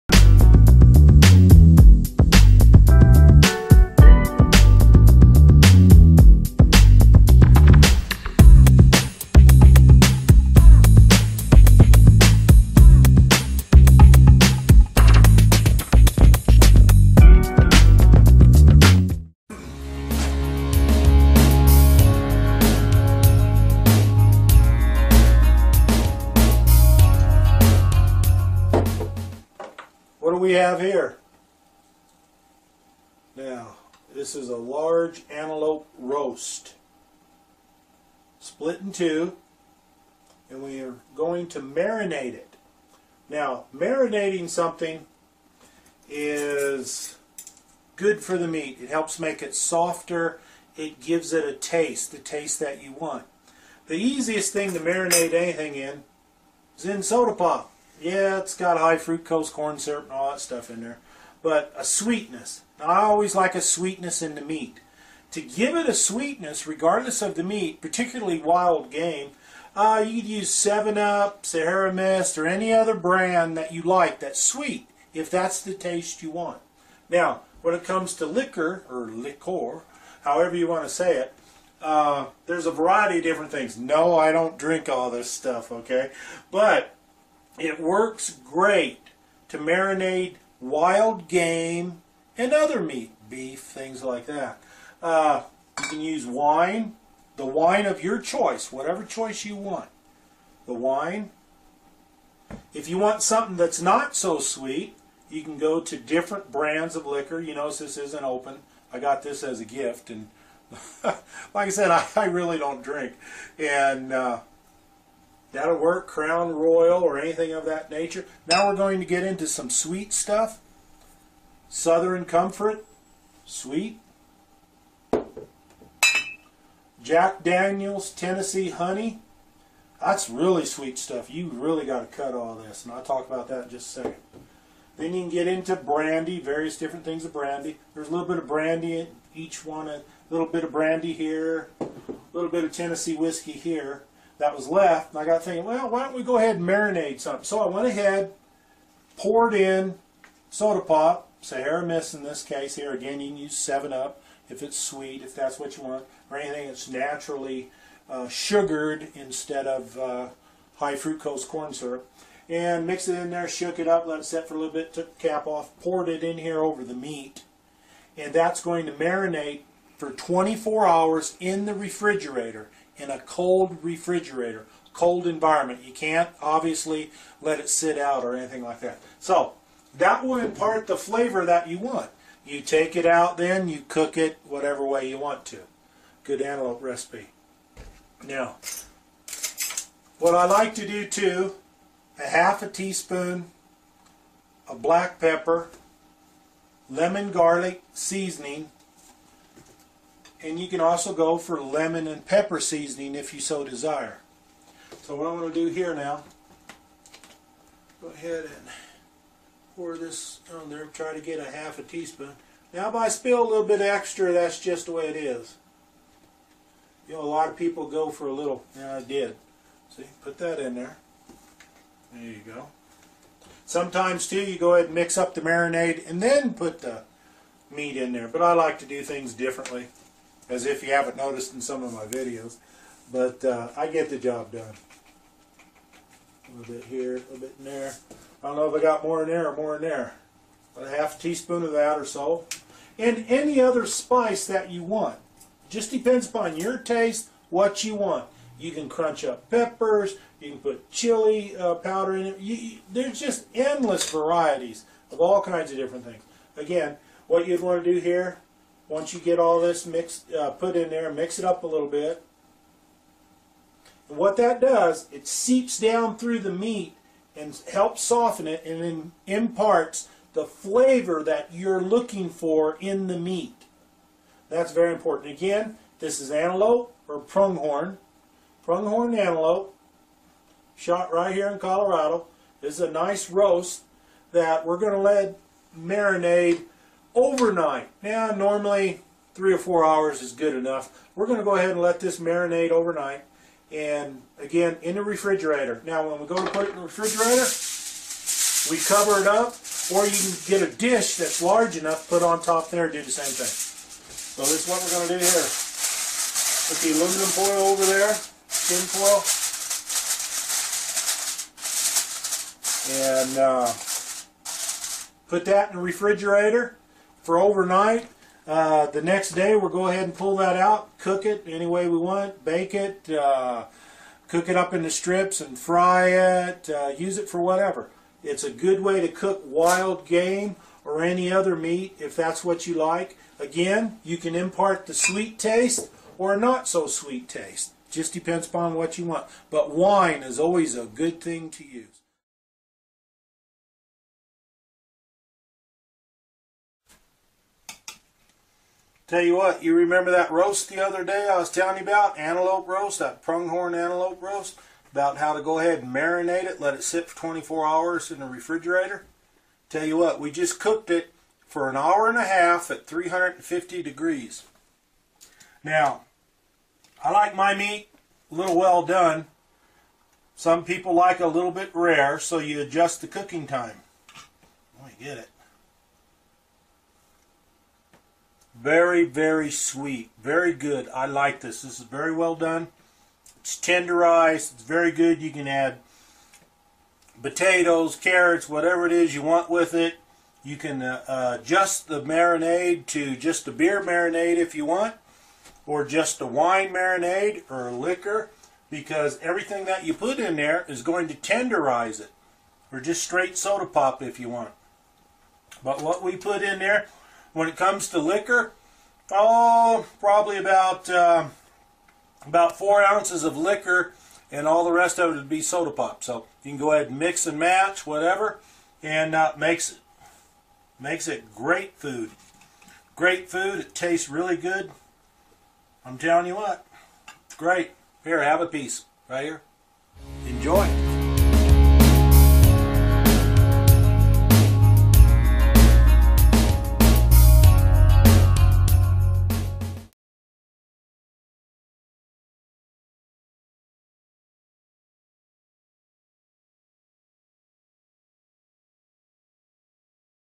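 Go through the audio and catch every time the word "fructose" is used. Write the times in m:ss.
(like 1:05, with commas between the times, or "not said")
0:58, 2:40.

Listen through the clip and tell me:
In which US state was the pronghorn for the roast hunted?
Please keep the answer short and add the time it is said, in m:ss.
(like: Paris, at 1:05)
Colorado, at 4:41.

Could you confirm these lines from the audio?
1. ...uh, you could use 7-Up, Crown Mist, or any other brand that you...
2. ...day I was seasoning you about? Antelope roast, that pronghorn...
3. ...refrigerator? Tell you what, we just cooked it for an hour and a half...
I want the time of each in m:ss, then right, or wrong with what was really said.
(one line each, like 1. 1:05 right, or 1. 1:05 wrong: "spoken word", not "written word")
1. 1:09 wrong: "Sierra", not "Crown"
2. 5:51 wrong: "telling", not "seasoning"
3. 5:58 right.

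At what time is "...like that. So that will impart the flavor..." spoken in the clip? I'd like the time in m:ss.
2:58.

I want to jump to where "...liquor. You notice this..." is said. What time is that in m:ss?
1:47.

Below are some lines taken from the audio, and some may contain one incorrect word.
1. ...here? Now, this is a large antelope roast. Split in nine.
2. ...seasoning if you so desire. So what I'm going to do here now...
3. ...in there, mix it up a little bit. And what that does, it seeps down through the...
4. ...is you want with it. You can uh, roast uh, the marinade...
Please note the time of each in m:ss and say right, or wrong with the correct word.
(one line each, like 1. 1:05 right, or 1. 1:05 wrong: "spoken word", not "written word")
1. 0:30 wrong: "two", not "nine"
2. 3:22 right
3. 4:20 right
4. 6:28 wrong: "adjust", not "roast".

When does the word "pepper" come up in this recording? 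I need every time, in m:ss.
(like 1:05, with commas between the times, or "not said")
3:15, 3:22, 4:09.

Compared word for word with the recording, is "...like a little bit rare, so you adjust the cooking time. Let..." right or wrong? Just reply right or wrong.
right.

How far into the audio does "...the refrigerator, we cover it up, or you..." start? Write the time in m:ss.
4:56.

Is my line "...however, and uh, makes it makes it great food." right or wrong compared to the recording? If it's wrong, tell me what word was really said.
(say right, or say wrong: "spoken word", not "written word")
wrong: "whatever", not "however".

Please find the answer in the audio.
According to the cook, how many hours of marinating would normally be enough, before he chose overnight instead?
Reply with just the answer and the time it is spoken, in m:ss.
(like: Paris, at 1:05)
3 or 4, at 4:49.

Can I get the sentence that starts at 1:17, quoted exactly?
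Now, when it comes to liquor, or liqueur, however you want to say it, uh, there's a variety of different things.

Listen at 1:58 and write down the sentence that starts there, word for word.
Now we're going to get into some sweet stuff.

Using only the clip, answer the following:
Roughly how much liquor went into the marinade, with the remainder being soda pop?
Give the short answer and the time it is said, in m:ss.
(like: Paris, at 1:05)
4 ounces, at 6:52.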